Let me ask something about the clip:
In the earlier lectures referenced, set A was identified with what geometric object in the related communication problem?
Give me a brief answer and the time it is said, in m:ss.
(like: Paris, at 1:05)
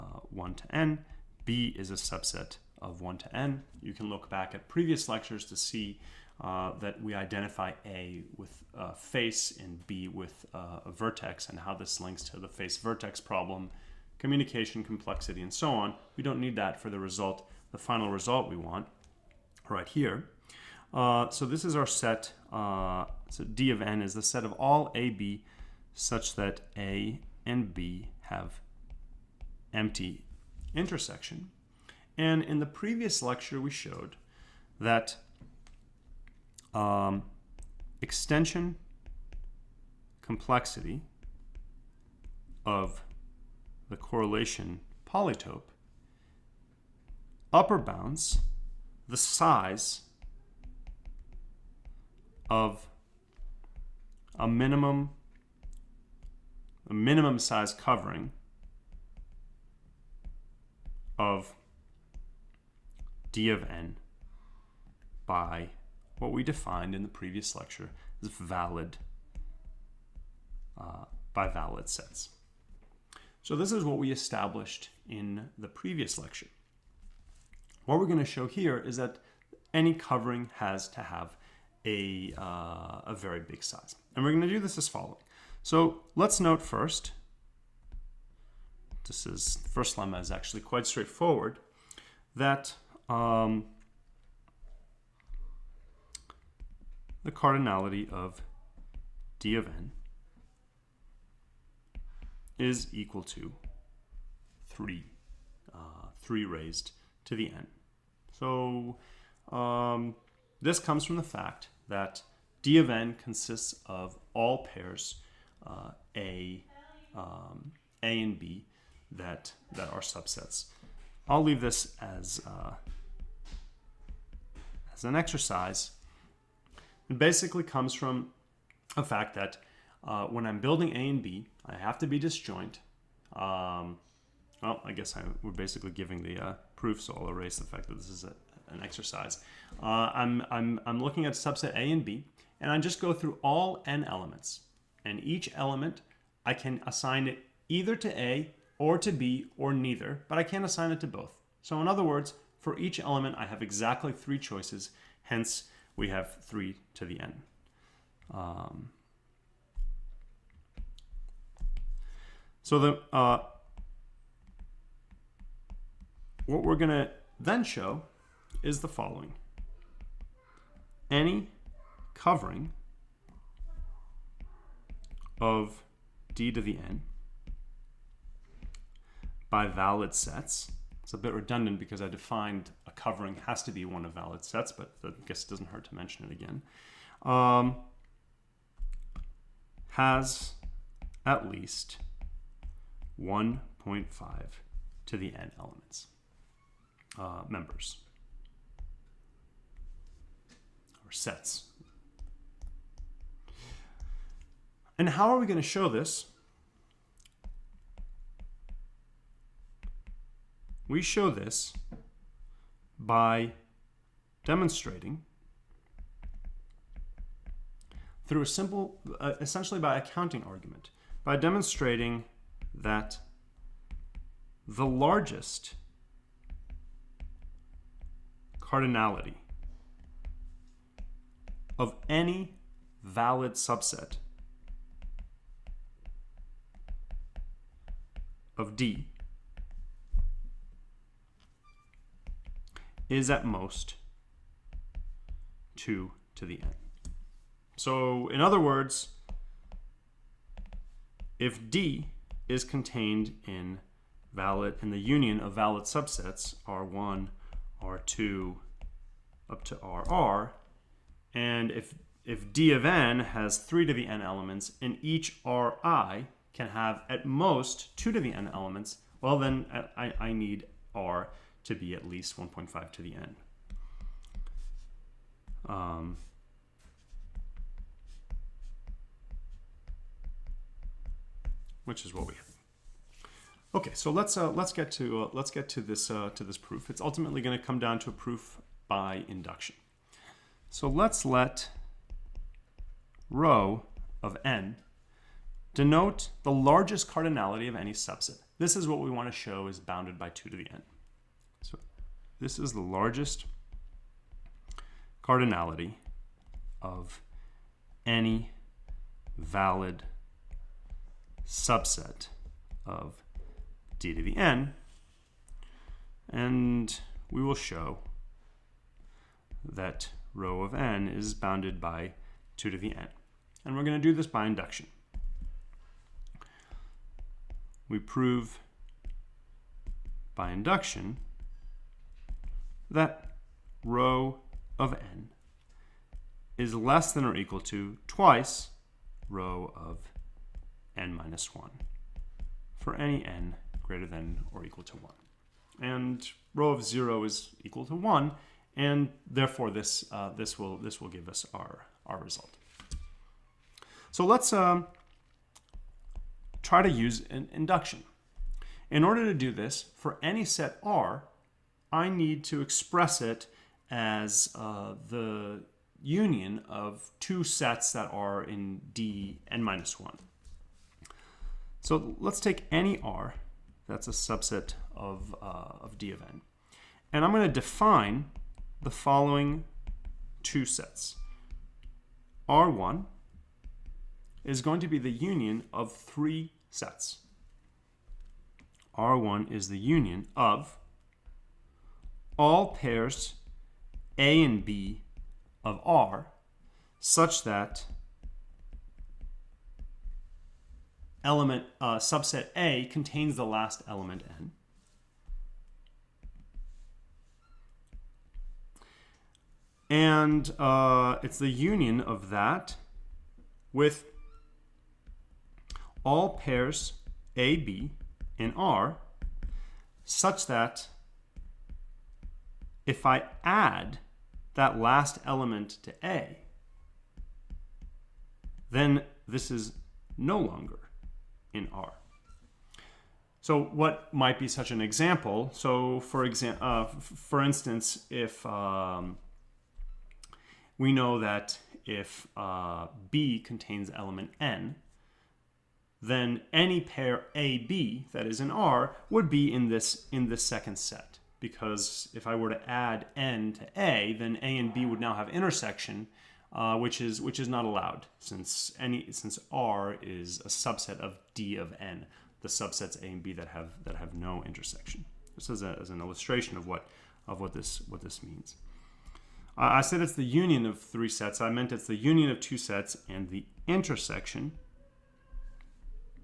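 A face, at 0:08.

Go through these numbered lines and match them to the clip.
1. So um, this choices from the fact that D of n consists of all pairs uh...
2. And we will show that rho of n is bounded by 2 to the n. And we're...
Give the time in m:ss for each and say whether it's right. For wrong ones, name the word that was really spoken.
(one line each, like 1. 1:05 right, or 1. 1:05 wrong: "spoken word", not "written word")
1. 1:48 wrong: "comes", not "choices"
2. 5:16 right.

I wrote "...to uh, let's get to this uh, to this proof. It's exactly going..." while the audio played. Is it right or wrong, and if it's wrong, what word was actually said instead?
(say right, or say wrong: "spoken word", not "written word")
wrong: "ultimately", not "exactly".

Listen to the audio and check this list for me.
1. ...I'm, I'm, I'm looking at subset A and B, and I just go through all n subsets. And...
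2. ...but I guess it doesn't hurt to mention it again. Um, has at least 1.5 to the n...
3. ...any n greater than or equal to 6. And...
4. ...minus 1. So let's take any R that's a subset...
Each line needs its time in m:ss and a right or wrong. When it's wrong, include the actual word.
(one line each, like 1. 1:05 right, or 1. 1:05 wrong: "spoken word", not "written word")
1. 2:20 wrong: "elements", not "subsets"
2. 3:04 right
3. 5:42 wrong: "1", not "6"
4. 6:09 right.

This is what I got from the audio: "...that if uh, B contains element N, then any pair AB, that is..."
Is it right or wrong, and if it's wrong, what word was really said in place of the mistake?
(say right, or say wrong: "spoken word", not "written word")
right.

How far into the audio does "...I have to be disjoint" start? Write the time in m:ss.
2:11.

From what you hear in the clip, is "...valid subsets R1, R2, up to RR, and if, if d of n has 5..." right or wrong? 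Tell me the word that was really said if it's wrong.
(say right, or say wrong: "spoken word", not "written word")
wrong: "3", not "5".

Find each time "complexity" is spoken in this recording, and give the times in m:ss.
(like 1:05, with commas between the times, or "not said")
0:14, 0:40.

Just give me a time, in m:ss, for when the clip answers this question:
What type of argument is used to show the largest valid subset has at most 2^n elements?
3:40.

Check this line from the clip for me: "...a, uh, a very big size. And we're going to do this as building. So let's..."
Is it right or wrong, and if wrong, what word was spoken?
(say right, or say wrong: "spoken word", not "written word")
wrong: "following", not "building".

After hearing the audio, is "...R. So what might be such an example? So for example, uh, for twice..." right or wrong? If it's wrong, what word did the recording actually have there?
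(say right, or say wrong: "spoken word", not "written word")
wrong: "instance", not "twice".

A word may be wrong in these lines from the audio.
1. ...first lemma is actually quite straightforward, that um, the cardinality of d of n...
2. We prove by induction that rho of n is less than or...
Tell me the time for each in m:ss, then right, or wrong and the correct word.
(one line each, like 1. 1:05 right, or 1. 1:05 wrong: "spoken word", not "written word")
1. 1:29 right
2. 5:27 right.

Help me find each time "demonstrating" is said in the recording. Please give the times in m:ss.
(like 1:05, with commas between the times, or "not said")
3:34, 3:41.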